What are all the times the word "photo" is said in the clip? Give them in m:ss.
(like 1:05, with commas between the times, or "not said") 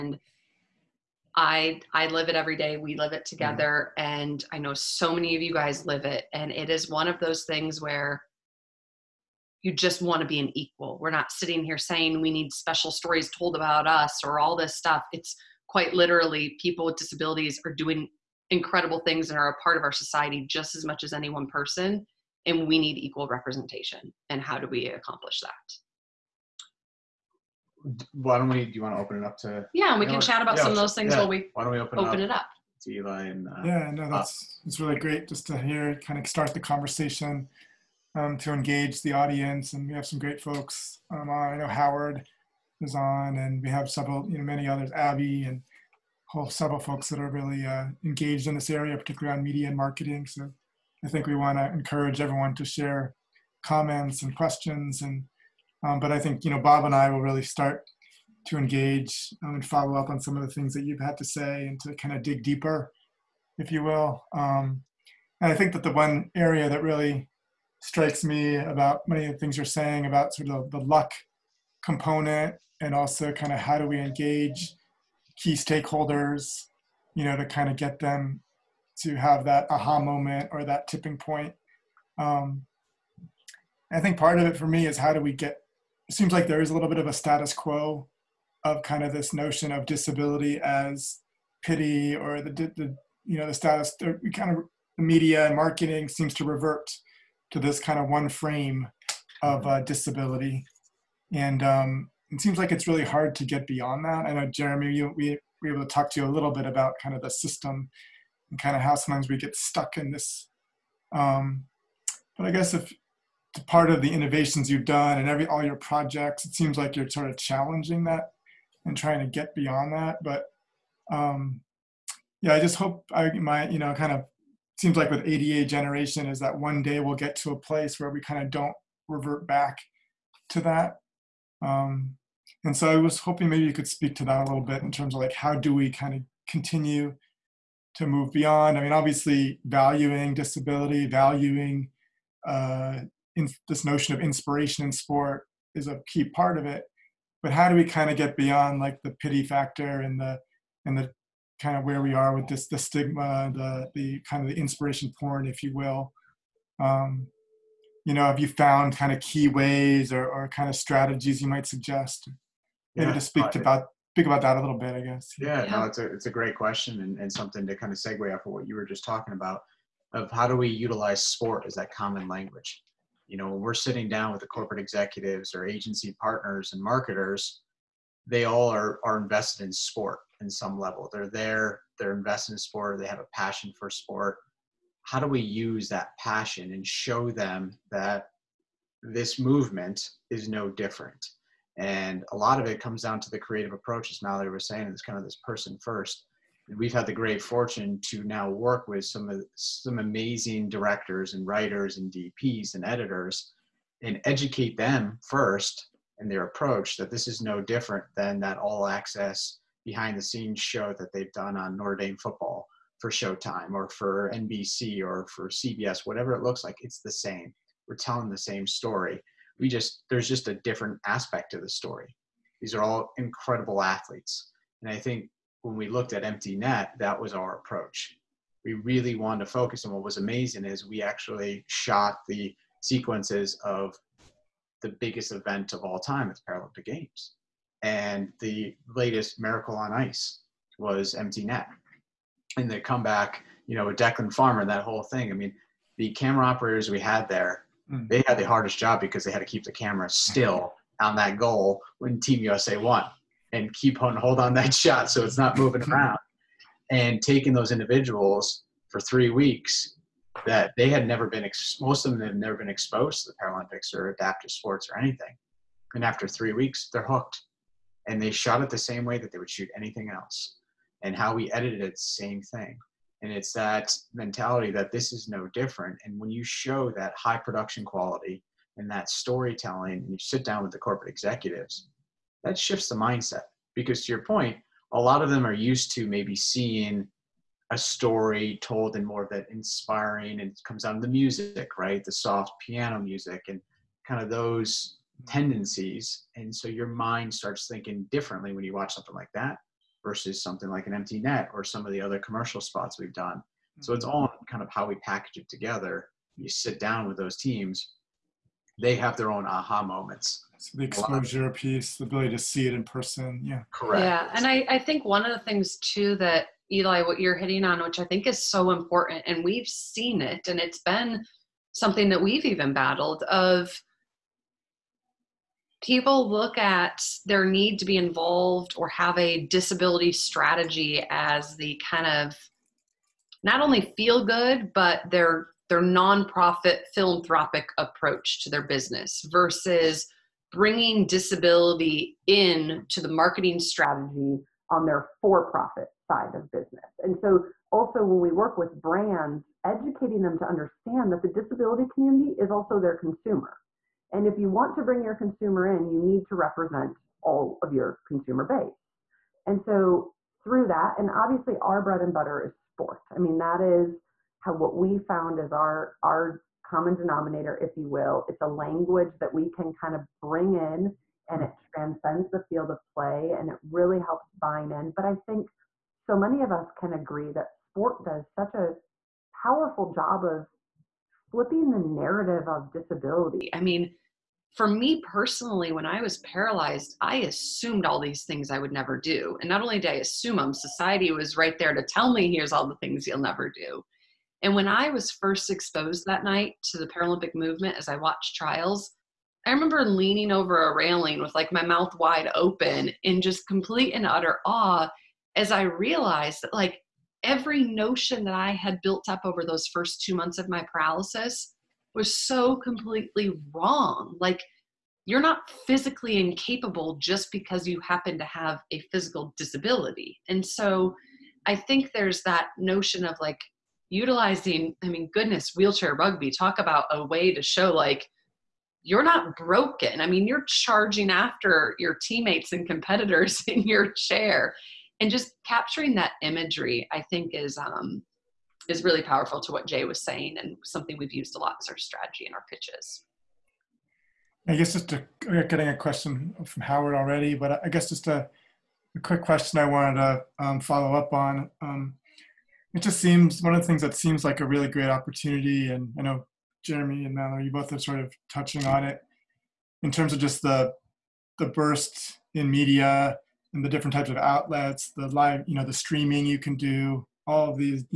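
not said.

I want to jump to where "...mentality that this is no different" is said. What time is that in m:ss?
4:34.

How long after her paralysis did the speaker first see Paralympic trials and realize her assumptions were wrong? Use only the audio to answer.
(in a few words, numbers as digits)
2 months.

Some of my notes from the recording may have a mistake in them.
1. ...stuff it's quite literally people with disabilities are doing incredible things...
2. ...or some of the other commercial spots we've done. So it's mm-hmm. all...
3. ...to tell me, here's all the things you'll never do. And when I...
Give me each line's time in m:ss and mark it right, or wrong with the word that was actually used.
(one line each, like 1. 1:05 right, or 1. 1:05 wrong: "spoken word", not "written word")
1. 0:14 right
2. 5:01 right
3. 6:31 right.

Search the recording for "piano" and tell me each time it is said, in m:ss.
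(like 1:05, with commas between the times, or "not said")
4:52.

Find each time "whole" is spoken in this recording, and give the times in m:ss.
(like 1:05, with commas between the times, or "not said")
0:46, 4:04.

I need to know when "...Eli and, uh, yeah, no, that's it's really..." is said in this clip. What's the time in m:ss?
0:32.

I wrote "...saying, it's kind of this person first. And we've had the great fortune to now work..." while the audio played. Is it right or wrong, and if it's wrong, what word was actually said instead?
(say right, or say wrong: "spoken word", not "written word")
right.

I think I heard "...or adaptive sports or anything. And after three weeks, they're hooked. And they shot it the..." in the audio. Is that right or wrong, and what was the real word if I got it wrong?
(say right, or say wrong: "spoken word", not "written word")
right.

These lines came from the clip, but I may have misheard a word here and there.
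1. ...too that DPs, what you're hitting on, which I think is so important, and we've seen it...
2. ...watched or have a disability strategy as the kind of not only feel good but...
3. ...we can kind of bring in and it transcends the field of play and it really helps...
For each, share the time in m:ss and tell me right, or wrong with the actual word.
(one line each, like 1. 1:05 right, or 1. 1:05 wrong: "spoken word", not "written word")
1. 5:15 wrong: "Eli", not "DPs"
2. 5:27 wrong: "involved", not "watched"
3. 6:09 right.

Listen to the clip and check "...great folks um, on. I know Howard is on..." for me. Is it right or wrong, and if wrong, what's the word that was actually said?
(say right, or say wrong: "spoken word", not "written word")
right.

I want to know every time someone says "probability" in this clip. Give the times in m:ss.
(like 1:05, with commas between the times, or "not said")
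not said.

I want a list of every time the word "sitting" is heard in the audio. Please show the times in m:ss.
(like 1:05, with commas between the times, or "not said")
0:11, 2:53.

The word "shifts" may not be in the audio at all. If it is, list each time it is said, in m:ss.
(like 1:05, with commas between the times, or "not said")
4:42.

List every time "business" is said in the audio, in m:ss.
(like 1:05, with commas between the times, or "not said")
5:38, 5:46.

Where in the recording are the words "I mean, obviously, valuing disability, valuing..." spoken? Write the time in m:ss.
2:18.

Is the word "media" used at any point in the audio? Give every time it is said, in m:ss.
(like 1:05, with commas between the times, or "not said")
0:49, 1:35, 7:42.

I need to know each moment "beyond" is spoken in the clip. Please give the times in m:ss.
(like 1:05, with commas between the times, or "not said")
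1:43, 1:59, 2:18, 2:28.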